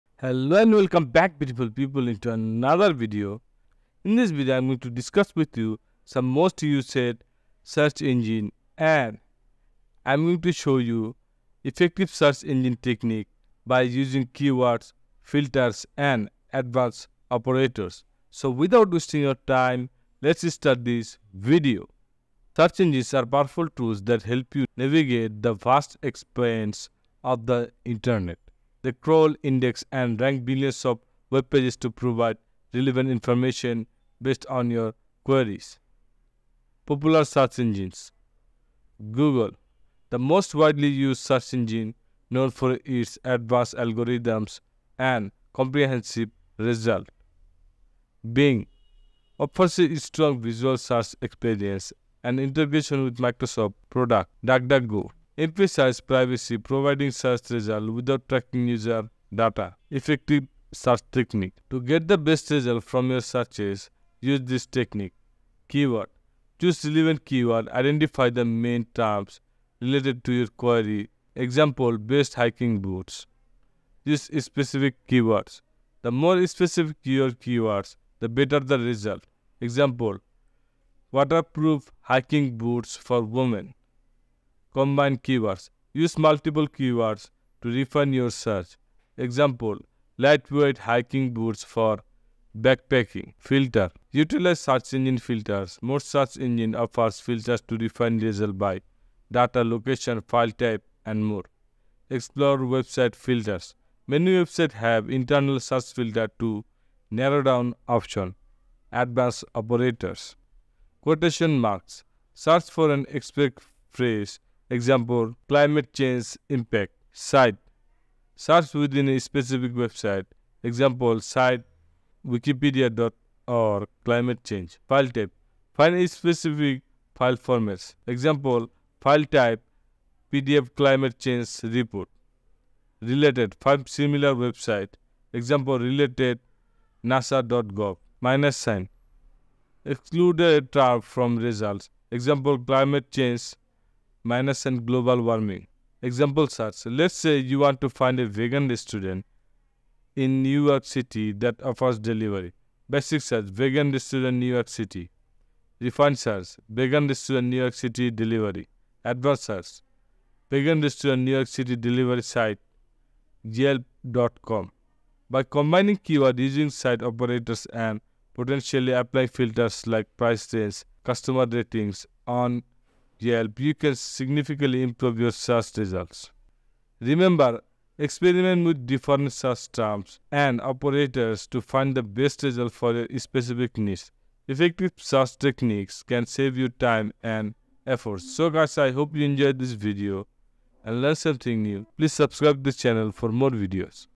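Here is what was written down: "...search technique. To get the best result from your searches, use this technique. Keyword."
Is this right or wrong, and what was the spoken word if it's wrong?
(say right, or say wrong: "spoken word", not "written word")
right.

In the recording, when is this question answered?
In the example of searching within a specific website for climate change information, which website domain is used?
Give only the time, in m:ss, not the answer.
2:02.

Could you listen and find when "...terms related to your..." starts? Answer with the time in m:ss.
1:08.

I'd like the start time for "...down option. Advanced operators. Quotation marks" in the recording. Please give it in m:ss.
1:47.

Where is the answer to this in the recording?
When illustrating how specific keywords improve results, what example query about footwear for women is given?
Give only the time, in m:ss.
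1:21.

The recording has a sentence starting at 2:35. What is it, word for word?
Refined search vegan restaurant New York City delivery.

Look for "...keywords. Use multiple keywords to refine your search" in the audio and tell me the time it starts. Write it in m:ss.
1:25.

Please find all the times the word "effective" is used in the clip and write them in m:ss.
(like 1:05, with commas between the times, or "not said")
0:11, 0:59, 3:04.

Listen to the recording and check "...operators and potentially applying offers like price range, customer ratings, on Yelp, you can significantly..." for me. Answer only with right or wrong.
wrong.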